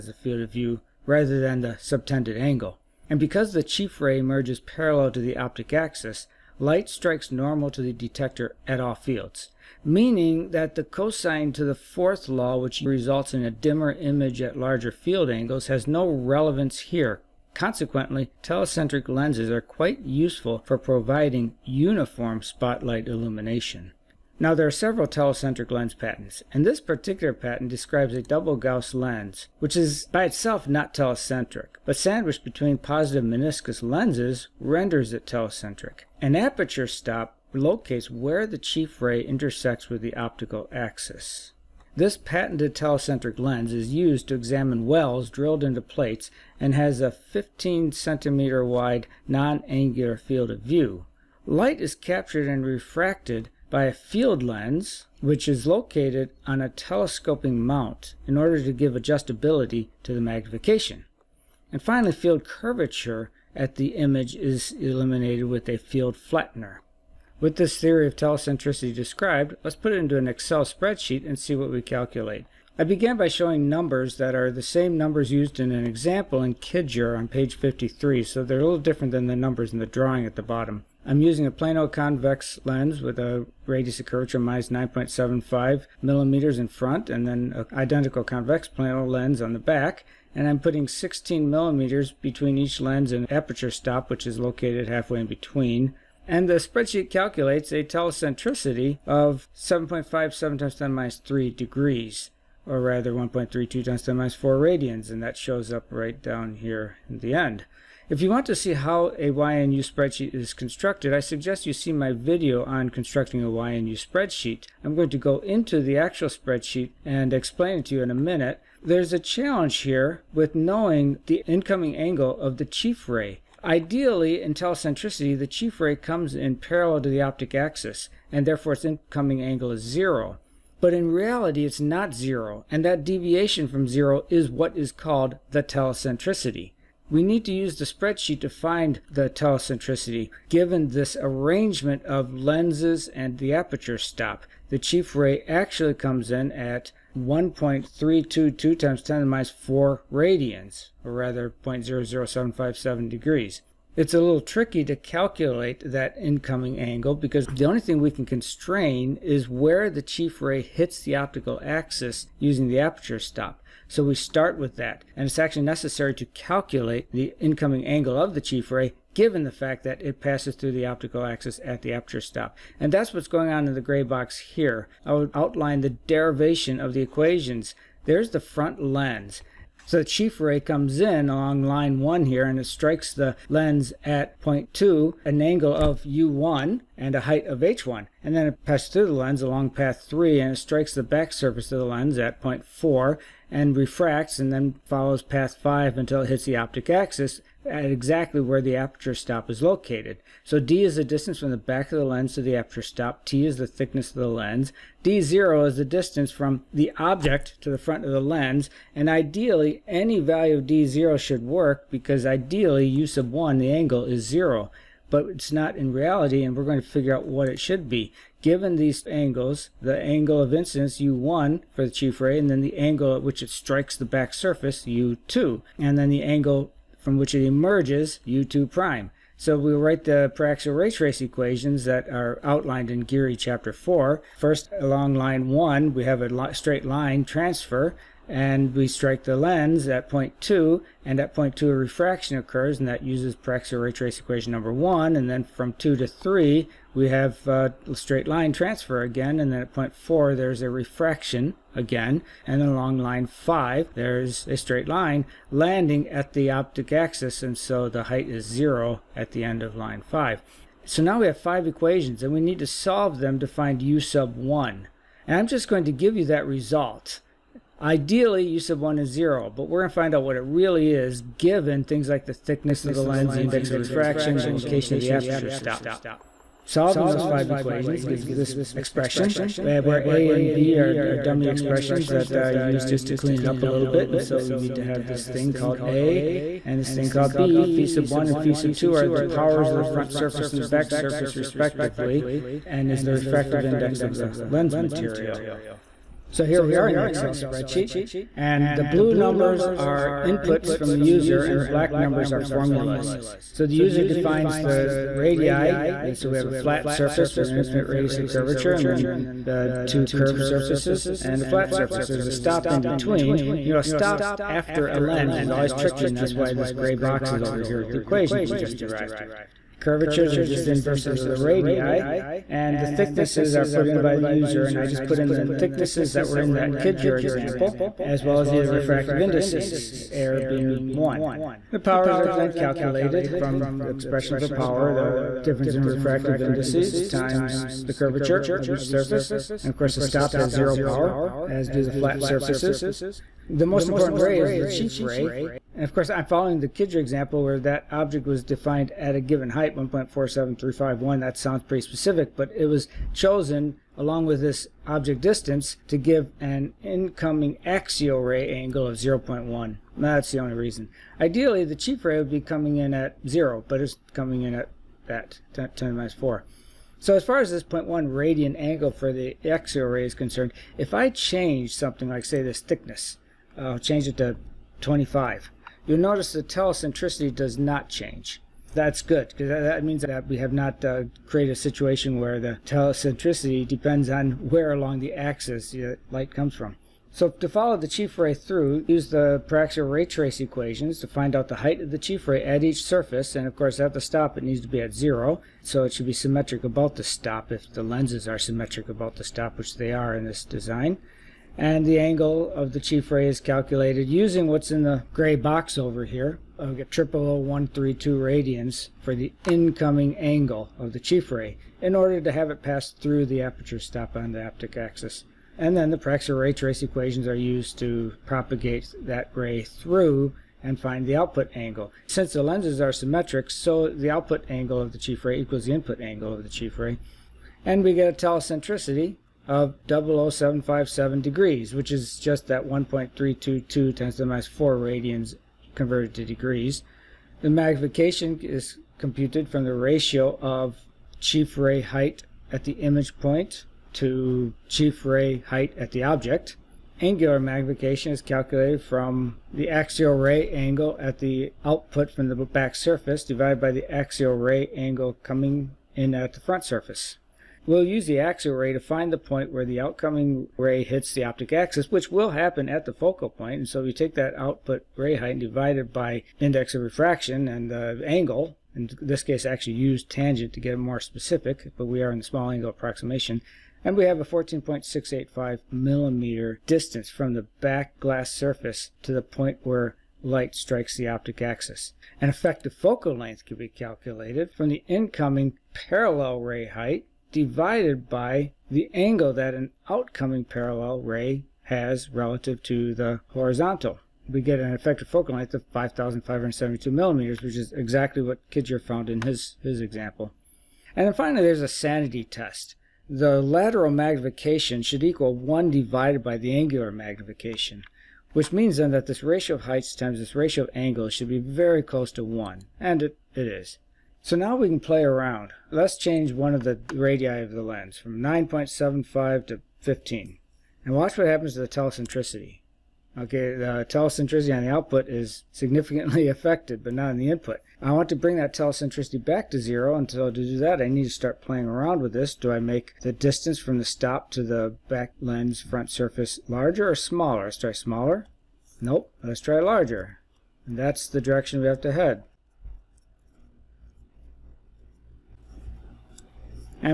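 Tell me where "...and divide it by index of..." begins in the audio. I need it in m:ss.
7:45.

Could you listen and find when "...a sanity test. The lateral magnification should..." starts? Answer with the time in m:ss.
8:21.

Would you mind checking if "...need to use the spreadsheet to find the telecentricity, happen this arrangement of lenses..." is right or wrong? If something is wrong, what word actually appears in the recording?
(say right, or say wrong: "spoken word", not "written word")
wrong: "given", not "happen".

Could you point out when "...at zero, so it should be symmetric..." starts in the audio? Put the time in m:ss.
6:34.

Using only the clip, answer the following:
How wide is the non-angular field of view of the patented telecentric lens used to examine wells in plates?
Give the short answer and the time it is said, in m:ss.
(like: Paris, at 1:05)
15 centimeters, at 0:47.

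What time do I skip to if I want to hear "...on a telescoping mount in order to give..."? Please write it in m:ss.
0:56.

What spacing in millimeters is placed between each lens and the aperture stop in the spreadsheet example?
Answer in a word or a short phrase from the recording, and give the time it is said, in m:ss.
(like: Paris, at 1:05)
16 millimeters, at 1:30.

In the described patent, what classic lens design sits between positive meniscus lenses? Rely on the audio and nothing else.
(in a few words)
double Gauss.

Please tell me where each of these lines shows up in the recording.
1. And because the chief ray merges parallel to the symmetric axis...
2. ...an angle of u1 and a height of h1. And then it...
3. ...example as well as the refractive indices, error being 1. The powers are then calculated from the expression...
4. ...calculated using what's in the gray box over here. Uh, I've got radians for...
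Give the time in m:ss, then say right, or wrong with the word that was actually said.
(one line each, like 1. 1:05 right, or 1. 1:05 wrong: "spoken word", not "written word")
1. 0:03 wrong: "optic", not "symmetric"
2. 3:05 right
3. 5:27 right
4. 6:43 right.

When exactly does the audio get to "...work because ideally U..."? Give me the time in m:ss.
3:31.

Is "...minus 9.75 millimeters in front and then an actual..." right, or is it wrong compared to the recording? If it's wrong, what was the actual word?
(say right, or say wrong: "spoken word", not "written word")
wrong: "identical", not "actual".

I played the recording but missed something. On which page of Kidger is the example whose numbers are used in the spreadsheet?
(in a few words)
53.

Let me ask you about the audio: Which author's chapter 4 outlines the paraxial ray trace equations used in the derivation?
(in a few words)
Geary.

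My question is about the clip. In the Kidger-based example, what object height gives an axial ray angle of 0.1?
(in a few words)
1.47351.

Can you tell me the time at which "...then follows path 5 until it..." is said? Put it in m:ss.
3:14.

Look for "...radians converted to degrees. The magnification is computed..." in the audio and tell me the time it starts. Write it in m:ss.
7:14.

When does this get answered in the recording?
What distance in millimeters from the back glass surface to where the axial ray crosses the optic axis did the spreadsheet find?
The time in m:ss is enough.
7:54.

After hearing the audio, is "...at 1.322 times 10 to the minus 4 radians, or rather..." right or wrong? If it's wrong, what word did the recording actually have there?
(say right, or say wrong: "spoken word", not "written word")
right.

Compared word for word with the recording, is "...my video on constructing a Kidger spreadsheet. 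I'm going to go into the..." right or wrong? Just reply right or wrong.
wrong.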